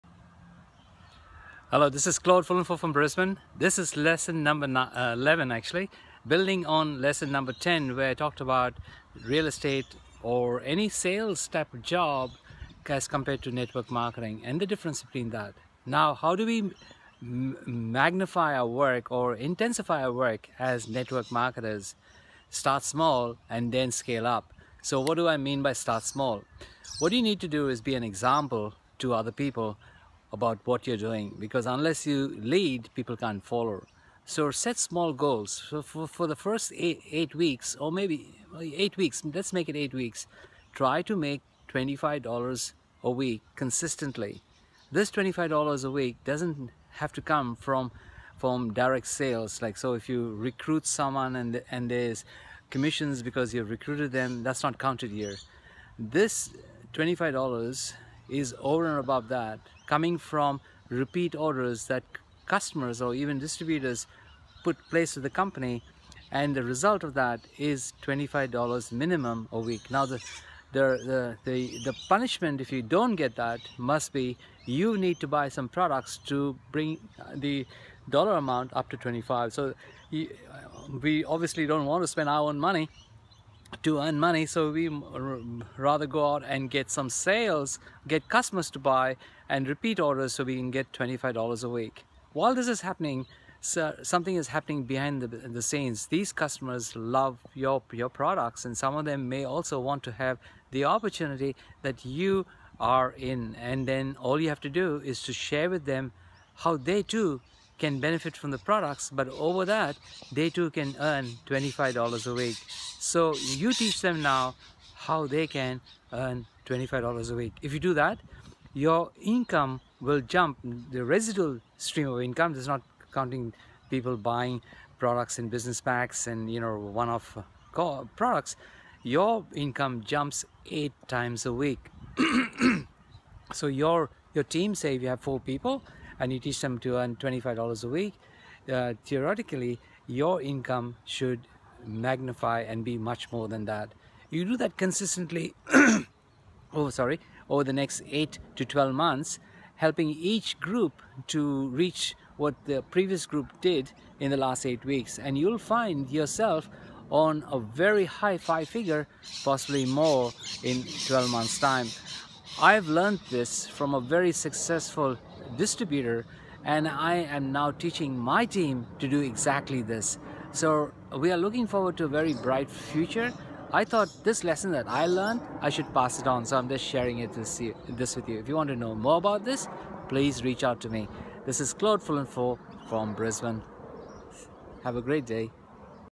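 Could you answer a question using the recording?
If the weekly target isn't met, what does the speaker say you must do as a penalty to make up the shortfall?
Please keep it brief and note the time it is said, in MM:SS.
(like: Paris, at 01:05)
buy some products, at 01:15.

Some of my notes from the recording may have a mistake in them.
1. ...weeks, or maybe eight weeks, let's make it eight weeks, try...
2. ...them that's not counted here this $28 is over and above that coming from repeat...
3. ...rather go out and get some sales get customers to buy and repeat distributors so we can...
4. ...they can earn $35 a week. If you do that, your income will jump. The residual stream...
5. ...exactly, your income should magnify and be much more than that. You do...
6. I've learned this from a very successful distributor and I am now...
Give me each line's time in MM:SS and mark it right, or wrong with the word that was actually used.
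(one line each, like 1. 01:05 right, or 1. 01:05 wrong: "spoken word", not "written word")
1. 00:37 right
2. 00:54 wrong: "25", not "28"
3. 01:25 wrong: "orders", not "distributors"
4. 01:55 wrong: "25", not "35"
5. 02:19 wrong: "theoretically", not "exactly"
6. 02:42 right.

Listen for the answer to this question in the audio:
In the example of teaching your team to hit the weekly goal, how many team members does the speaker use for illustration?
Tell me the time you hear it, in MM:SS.
02:15.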